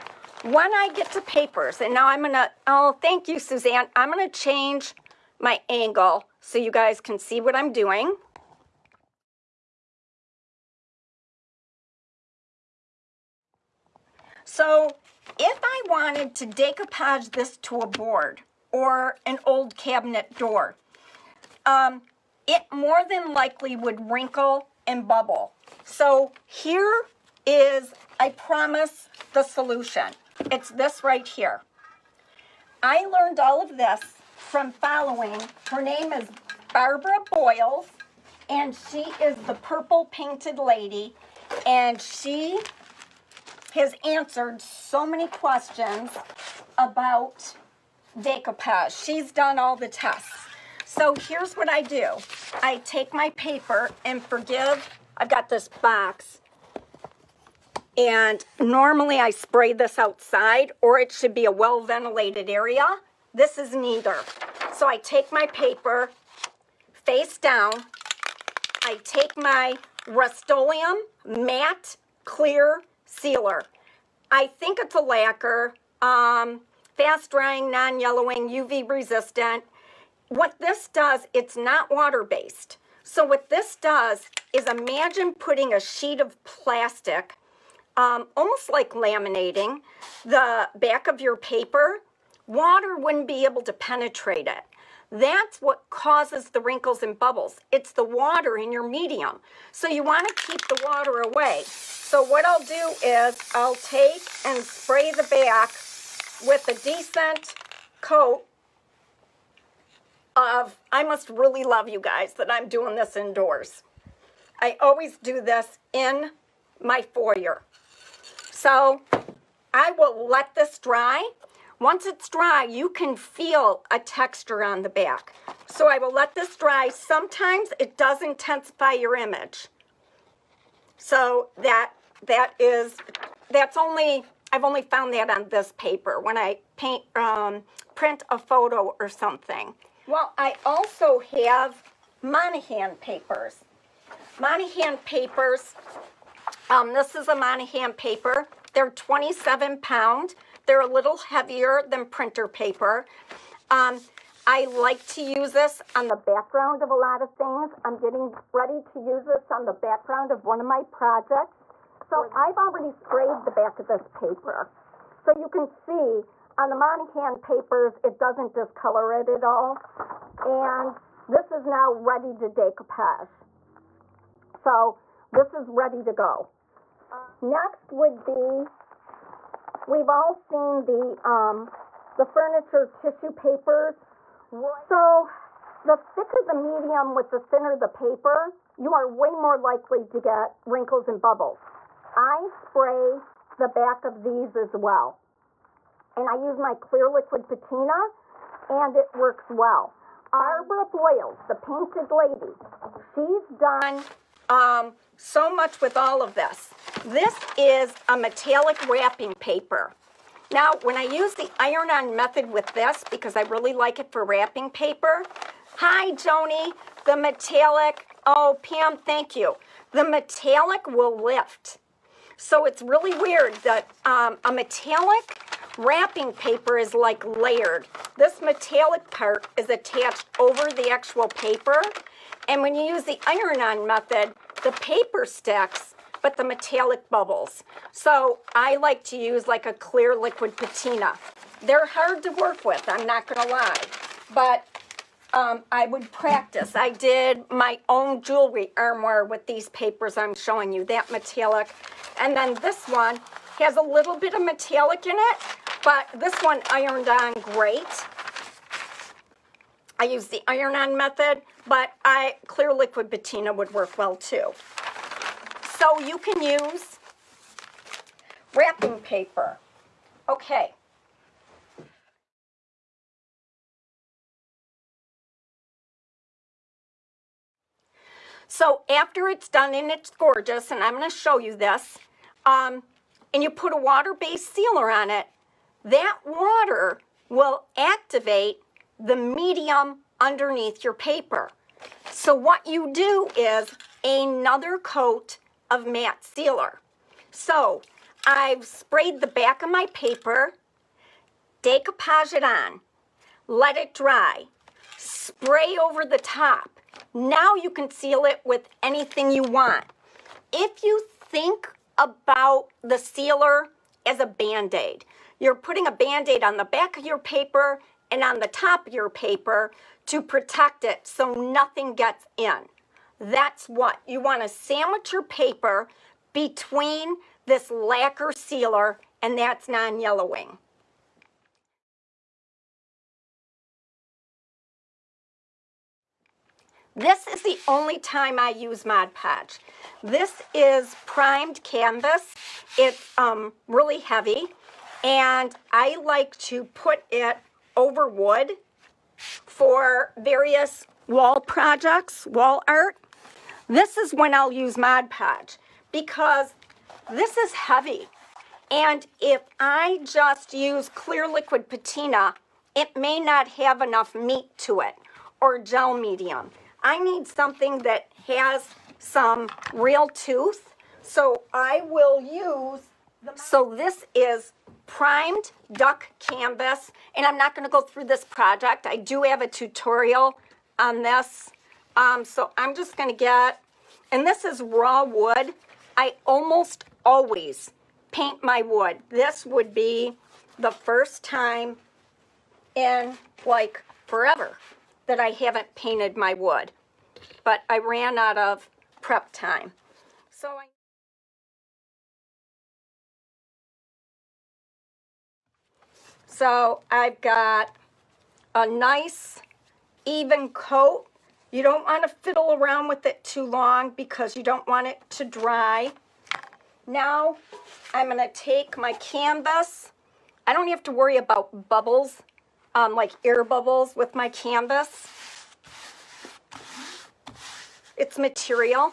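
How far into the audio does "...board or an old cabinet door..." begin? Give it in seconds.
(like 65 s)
17 s.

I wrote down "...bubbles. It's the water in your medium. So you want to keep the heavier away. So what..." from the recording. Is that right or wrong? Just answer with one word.
wrong.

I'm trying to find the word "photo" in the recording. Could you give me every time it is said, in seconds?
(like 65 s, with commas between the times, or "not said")
138 s.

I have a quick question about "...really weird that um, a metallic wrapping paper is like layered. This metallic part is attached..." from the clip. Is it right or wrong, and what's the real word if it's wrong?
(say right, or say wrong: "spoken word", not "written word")
right.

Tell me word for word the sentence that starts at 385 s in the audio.
I almost always paint my wood.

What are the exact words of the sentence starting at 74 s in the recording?
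I think it's a lacquer, um, fast drying, non-yellowing, UV resistant.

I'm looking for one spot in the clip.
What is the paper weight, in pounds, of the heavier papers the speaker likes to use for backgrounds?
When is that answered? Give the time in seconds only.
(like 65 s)
148 s.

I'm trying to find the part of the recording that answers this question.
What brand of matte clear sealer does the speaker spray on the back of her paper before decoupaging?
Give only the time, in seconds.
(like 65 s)
70 s.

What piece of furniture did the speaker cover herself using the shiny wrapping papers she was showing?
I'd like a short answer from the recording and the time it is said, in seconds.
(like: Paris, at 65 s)
jewelry armoire, at 248 s.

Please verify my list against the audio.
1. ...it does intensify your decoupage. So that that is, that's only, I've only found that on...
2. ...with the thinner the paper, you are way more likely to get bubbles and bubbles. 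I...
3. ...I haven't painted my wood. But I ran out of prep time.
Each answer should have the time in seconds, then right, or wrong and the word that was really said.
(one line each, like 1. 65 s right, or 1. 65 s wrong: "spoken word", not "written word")
1. 127 s wrong: "image", not "decoupage"
2. 187 s wrong: "wrinkles", not "bubbles"
3. 395 s right.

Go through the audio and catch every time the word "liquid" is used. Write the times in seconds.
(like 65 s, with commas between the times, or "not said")
197 s, 240 s, 262 s, 361 s.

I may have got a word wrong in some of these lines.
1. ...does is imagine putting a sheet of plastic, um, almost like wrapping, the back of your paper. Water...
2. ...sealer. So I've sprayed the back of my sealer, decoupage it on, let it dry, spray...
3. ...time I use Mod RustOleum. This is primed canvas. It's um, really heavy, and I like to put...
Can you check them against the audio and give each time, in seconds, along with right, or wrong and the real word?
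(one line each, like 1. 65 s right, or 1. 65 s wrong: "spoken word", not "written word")
1. 83 s wrong: "laminating", not "wrapping"
2. 296 s wrong: "paper", not "sealer"
3. 337 s wrong: "Podge", not "RustOleum".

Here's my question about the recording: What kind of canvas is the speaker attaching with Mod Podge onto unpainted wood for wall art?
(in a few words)
primed duck canvas.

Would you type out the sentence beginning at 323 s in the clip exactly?
That's what you want to sandwich your paper between this lacquer sealer and that's non-yellowing.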